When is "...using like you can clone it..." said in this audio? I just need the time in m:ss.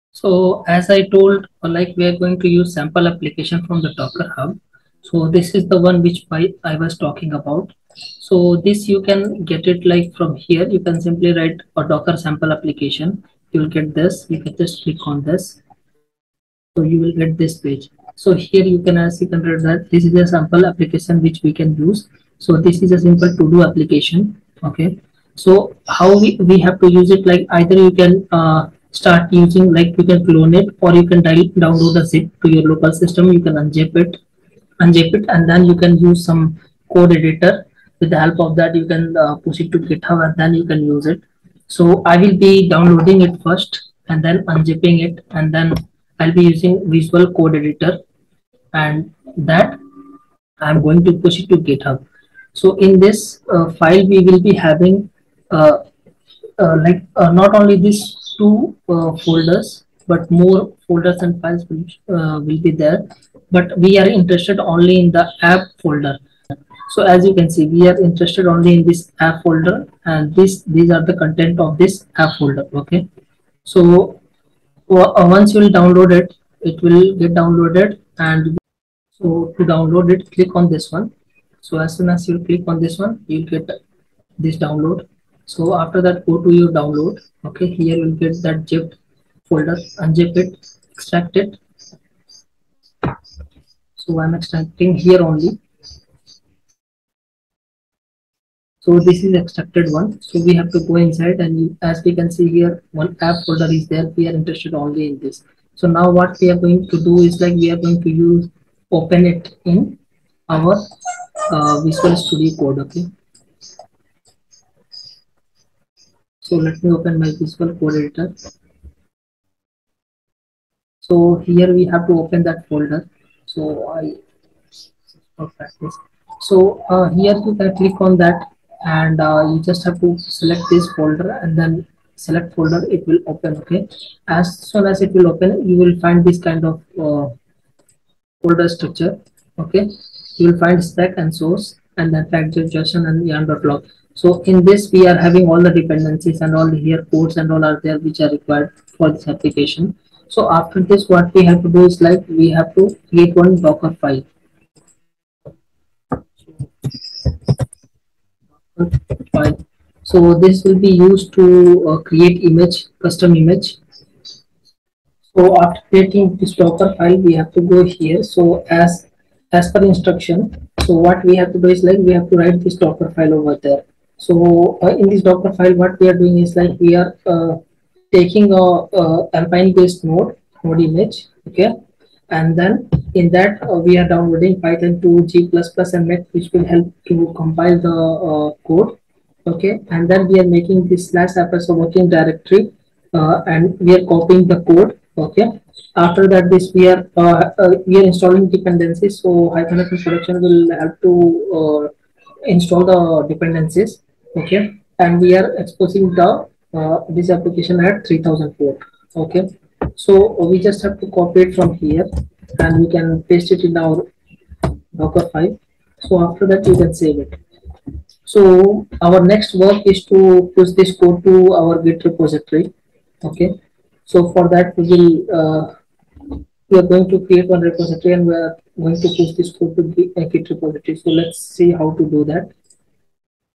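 0:29.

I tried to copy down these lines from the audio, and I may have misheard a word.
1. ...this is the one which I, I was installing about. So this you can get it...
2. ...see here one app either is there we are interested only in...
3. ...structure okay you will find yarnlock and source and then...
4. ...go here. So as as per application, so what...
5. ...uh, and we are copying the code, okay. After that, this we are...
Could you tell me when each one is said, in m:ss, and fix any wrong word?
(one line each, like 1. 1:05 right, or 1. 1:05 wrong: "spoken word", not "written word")
1. 0:05 wrong: "talking", not "installing"
2. 1:42 wrong: "folder", not "either"
3. 2:18 wrong: "stack", not "yarnlock"
4. 2:47 wrong: "instruction", not "application"
5. 3:13 right.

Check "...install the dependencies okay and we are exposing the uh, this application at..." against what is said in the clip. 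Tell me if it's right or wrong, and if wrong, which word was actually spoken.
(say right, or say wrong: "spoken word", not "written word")
right.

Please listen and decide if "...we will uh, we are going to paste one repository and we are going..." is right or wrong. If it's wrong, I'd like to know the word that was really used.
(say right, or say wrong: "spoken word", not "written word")
wrong: "create", not "paste".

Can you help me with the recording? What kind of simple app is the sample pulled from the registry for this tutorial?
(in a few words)
to-do application.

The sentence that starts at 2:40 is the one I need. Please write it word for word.
So this will be used to uh, create image, custom image.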